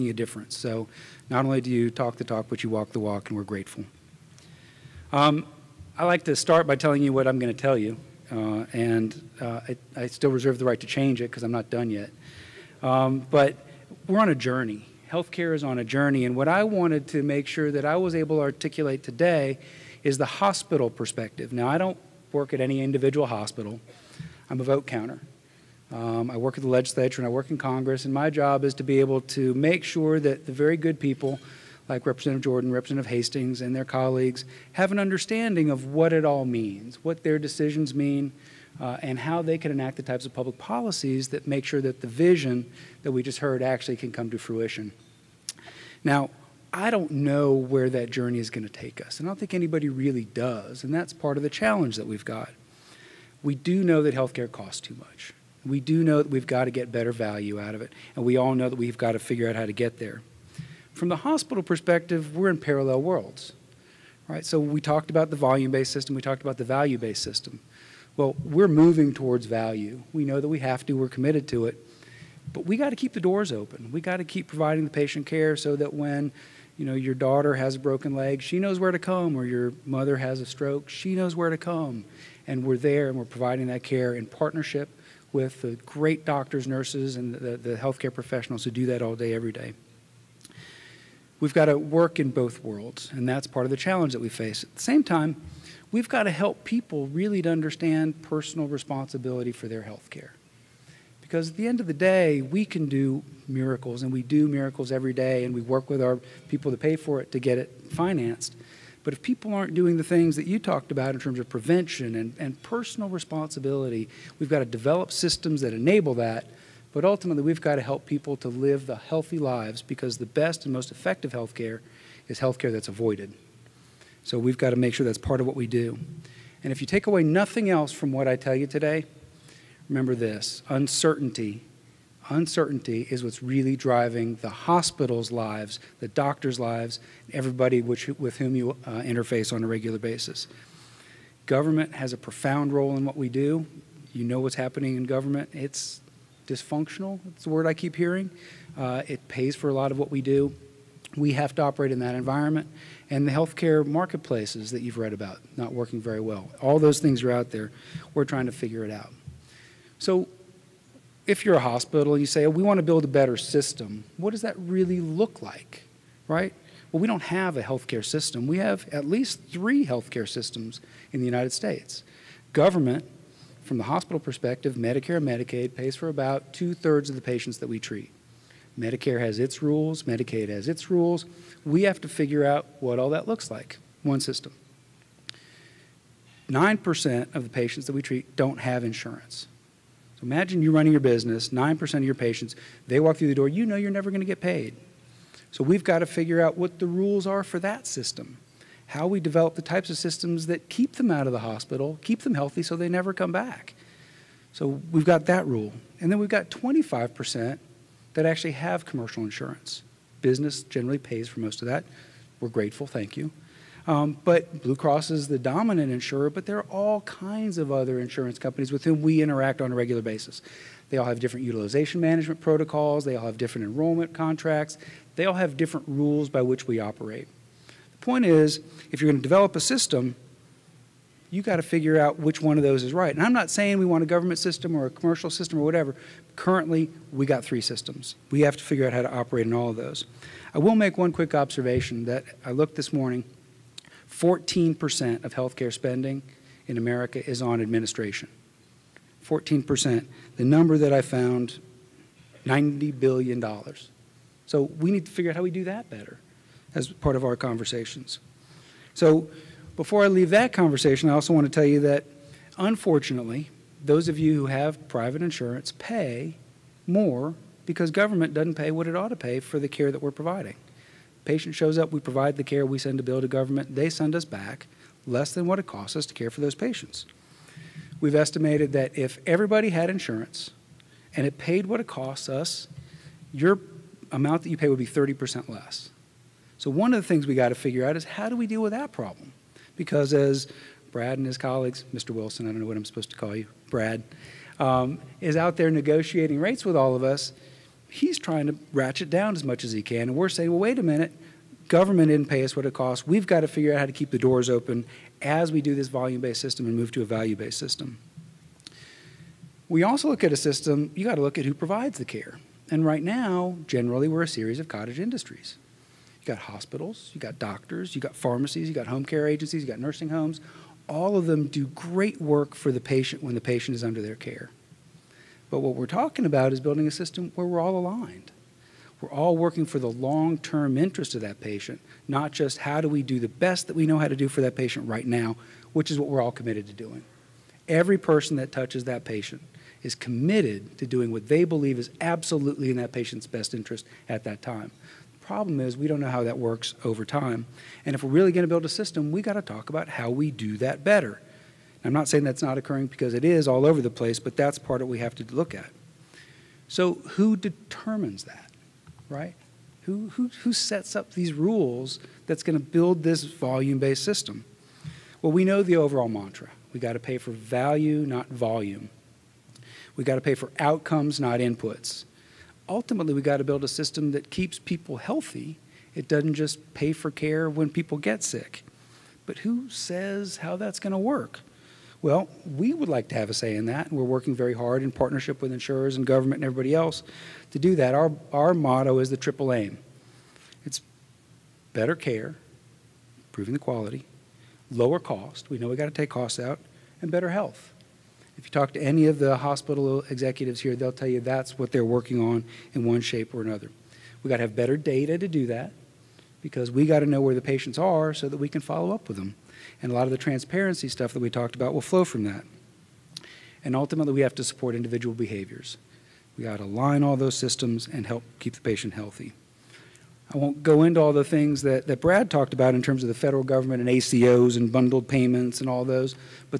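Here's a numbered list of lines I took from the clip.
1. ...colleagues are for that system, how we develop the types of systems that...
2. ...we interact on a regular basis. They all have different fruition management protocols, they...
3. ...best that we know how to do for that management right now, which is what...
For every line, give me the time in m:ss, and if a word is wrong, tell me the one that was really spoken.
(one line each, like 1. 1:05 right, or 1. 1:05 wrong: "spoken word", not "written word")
1. 3:16 wrong: "rules", not "colleagues"
2. 3:39 wrong: "utilization", not "fruition"
3. 5:33 wrong: "patient", not "management".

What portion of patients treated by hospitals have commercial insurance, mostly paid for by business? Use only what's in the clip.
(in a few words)
25%.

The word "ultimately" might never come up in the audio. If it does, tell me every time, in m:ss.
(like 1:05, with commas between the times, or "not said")
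1:57, 6:12, 6:53.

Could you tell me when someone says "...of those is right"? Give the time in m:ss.
3:52.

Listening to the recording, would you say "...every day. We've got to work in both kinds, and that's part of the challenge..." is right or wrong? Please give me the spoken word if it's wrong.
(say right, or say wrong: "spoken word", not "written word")
wrong: "worlds", not "kinds".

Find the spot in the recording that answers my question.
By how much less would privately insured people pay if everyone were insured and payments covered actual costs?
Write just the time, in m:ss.
4:44.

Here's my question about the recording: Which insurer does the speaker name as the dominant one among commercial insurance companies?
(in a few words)
Blue Cross.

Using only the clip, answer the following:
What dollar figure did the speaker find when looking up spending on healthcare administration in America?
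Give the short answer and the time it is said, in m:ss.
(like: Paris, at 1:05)
$90 billion, at 4:12.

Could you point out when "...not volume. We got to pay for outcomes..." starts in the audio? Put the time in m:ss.
6:08.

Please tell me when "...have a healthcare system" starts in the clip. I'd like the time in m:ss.
2:47.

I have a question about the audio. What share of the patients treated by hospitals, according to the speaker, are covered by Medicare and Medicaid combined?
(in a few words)
two thirds.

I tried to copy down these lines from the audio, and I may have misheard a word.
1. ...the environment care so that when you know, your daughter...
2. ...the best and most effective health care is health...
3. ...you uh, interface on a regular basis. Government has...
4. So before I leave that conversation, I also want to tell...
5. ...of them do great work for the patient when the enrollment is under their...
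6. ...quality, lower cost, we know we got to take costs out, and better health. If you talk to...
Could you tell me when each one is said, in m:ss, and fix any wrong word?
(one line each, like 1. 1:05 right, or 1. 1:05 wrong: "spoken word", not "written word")
1. 1:14 wrong: "patient", not "environment"
2. 2:00 right
3. 2:18 right
4. 4:18 right
5. 5:21 wrong: "patient", not "enrollment"
6. 6:33 right.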